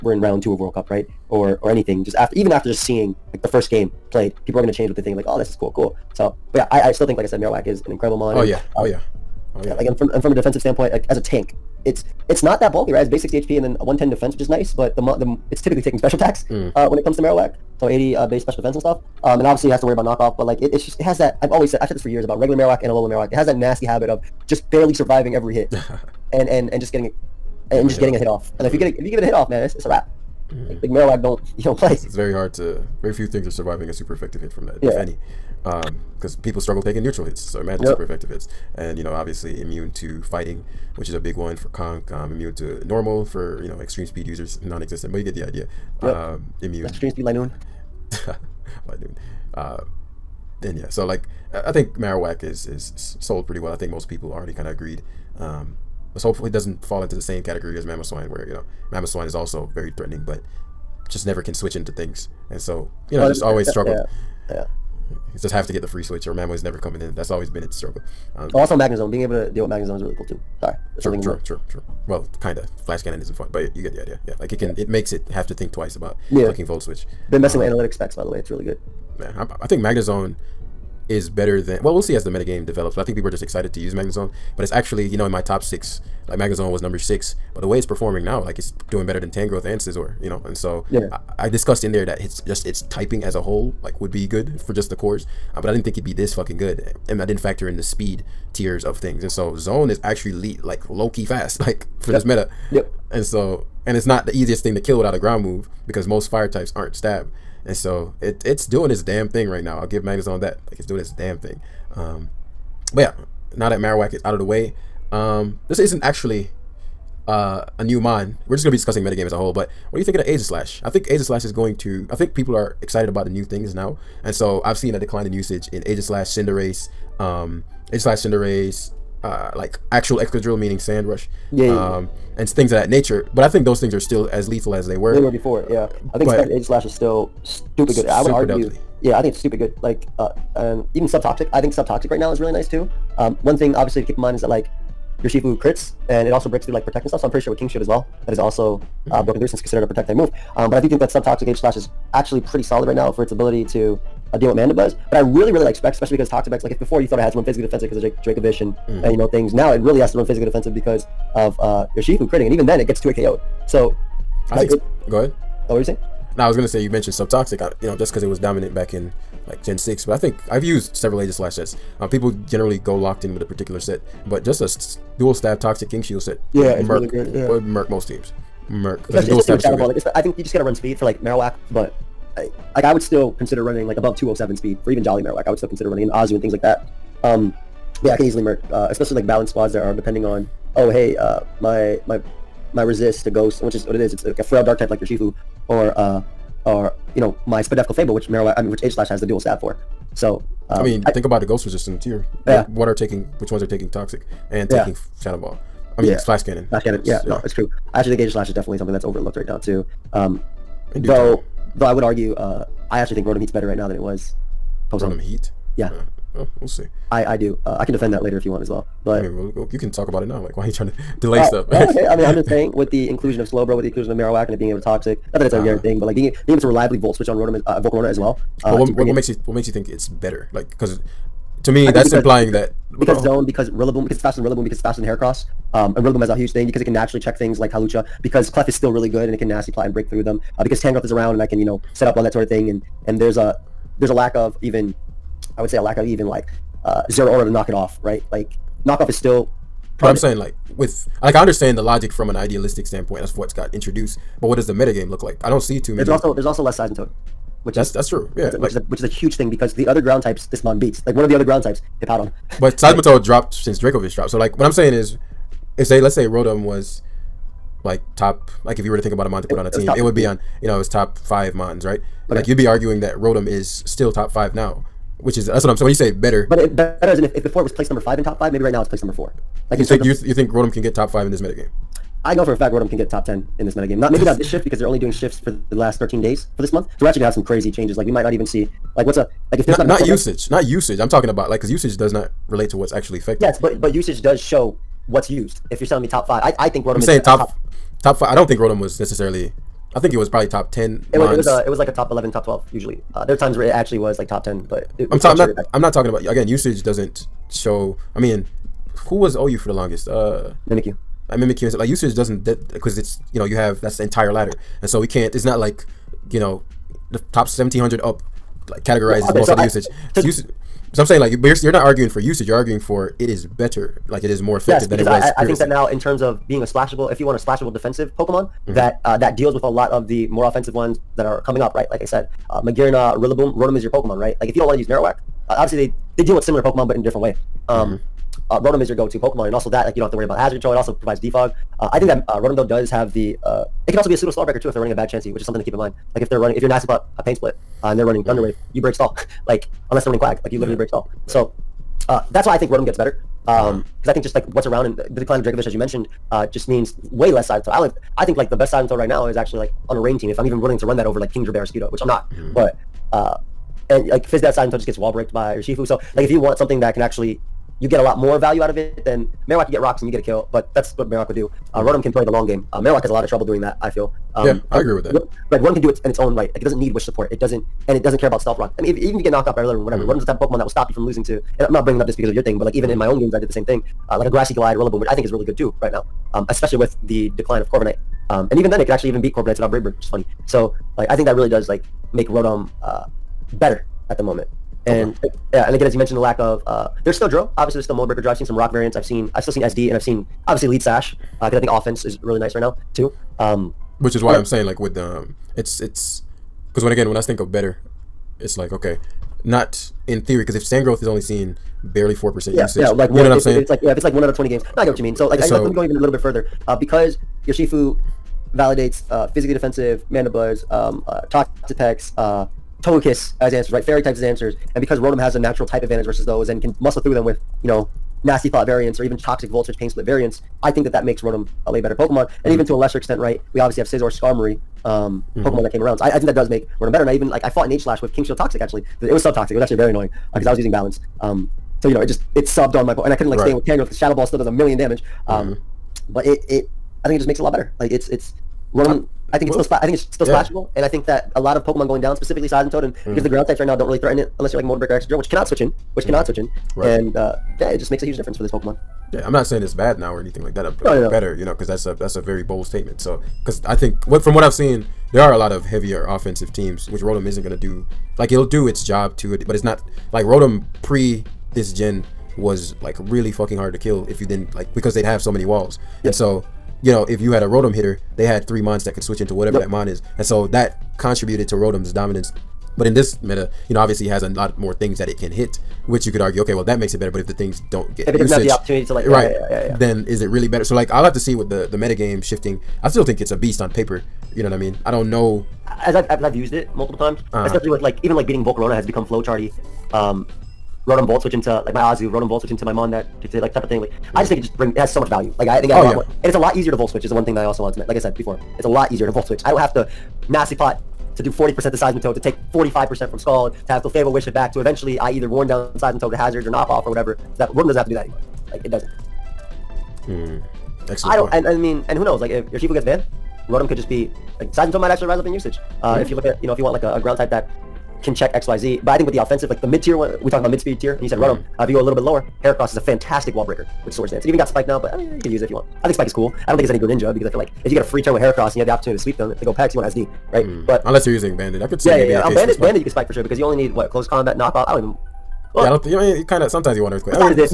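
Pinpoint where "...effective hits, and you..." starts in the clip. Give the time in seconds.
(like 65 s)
38 s.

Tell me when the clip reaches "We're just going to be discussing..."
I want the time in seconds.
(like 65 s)
118 s.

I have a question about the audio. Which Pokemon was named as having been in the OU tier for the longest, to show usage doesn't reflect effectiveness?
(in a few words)
Mimikyu.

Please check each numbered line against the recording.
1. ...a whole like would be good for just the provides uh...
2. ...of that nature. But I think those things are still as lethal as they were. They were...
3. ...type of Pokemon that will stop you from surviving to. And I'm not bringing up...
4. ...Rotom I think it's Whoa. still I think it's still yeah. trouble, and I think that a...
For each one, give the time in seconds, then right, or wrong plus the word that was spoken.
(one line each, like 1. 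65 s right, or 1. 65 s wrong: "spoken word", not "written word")
1. 93 s wrong: "cores", not "provides"
2. 132 s right
3. 380 s wrong: "losing", not "surviving"
4. 448 s wrong: "splashable", not "trouble".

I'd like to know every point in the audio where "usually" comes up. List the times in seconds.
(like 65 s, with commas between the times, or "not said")
302 s.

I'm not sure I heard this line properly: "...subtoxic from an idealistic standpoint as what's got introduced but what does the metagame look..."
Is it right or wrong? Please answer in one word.
wrong.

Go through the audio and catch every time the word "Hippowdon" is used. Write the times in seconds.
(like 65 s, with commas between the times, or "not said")
262 s.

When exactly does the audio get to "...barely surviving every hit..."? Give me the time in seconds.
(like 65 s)
24 s.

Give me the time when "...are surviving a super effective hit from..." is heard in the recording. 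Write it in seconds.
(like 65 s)
33 s.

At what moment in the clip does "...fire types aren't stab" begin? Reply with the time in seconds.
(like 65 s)
106 s.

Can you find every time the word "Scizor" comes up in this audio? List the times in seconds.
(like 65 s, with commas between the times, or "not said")
89 s, 433 s.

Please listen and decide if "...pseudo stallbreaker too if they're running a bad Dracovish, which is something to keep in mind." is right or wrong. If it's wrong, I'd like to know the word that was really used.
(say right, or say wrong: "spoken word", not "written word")
wrong: "Chansey", not "Dracovish".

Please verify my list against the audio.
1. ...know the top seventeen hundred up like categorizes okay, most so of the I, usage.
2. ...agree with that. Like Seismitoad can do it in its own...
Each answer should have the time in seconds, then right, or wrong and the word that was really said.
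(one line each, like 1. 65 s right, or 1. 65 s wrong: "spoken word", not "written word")
1. 316 s right
2. 374 s wrong: "Rotom", not "Seismitoad".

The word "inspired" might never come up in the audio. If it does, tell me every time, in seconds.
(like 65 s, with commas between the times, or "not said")
not said.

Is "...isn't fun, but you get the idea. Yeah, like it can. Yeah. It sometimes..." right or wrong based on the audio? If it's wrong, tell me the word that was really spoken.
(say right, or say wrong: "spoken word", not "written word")
wrong: "makes", not "sometimes".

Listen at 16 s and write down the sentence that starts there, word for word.
uh, when it comes to Marowak.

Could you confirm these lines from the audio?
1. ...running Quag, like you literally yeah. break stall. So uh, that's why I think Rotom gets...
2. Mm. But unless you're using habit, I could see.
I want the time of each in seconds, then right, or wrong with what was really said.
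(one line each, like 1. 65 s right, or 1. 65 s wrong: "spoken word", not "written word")
1. 350 s right
2. 540 s wrong: "bandit", not "habit".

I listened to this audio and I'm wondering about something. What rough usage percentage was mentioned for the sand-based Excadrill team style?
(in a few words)
4%.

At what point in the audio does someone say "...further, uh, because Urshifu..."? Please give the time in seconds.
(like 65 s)
416 s.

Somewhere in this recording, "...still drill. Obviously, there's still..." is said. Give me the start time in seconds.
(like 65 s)
397 s.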